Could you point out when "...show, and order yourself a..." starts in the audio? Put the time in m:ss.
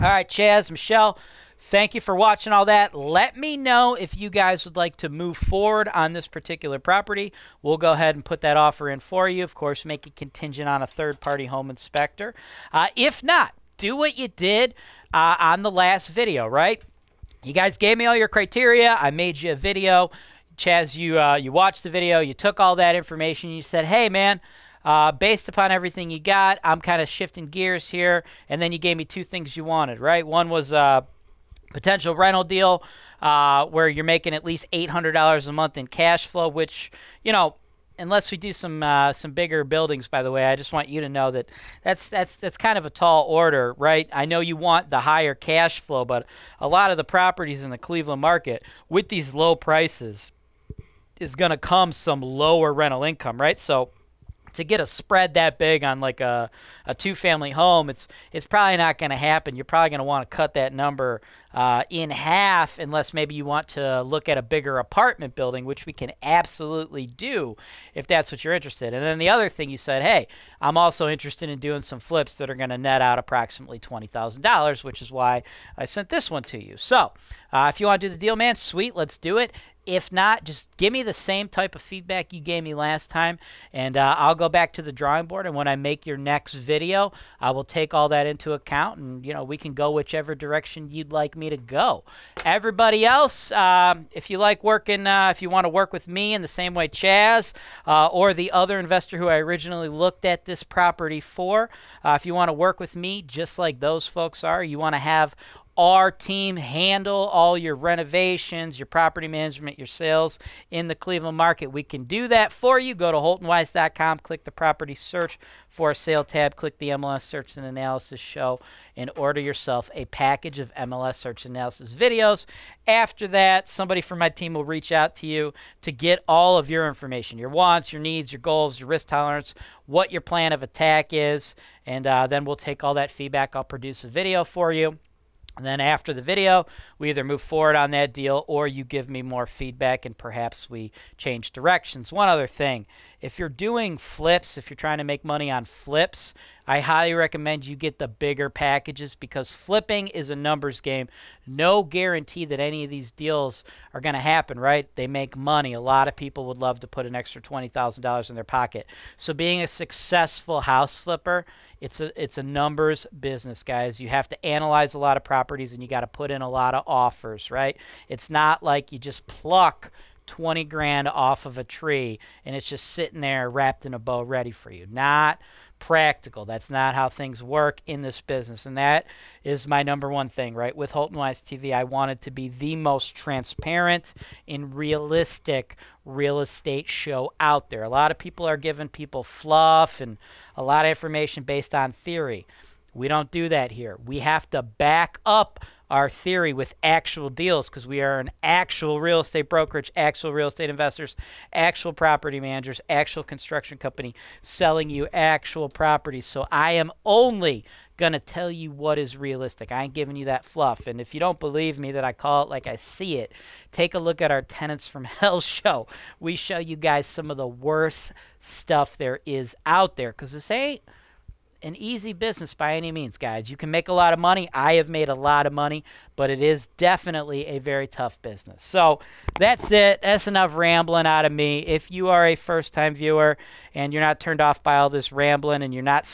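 1:58.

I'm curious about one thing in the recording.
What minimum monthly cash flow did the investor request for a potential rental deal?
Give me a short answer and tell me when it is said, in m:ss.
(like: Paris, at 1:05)
$800, at 0:34.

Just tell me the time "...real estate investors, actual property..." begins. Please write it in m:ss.
3:20.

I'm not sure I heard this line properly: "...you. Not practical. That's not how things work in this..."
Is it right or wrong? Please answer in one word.
right.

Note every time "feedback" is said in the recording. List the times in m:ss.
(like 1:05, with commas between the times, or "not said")
1:21, 2:13, 2:19.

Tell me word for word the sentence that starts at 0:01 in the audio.
Thank you for watching all that.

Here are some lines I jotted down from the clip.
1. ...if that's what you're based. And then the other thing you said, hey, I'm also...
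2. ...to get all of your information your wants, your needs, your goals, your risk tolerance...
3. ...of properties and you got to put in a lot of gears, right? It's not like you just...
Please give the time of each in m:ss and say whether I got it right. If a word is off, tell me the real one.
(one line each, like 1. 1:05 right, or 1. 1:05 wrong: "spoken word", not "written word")
1. 1:07 wrong: "interested", not "based"
2. 2:05 right
3. 2:45 wrong: "offers", not "gears".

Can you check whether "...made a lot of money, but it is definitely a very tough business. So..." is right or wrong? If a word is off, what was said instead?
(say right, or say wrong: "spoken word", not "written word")
right.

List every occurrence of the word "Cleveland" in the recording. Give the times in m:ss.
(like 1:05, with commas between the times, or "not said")
0:47, 1:50.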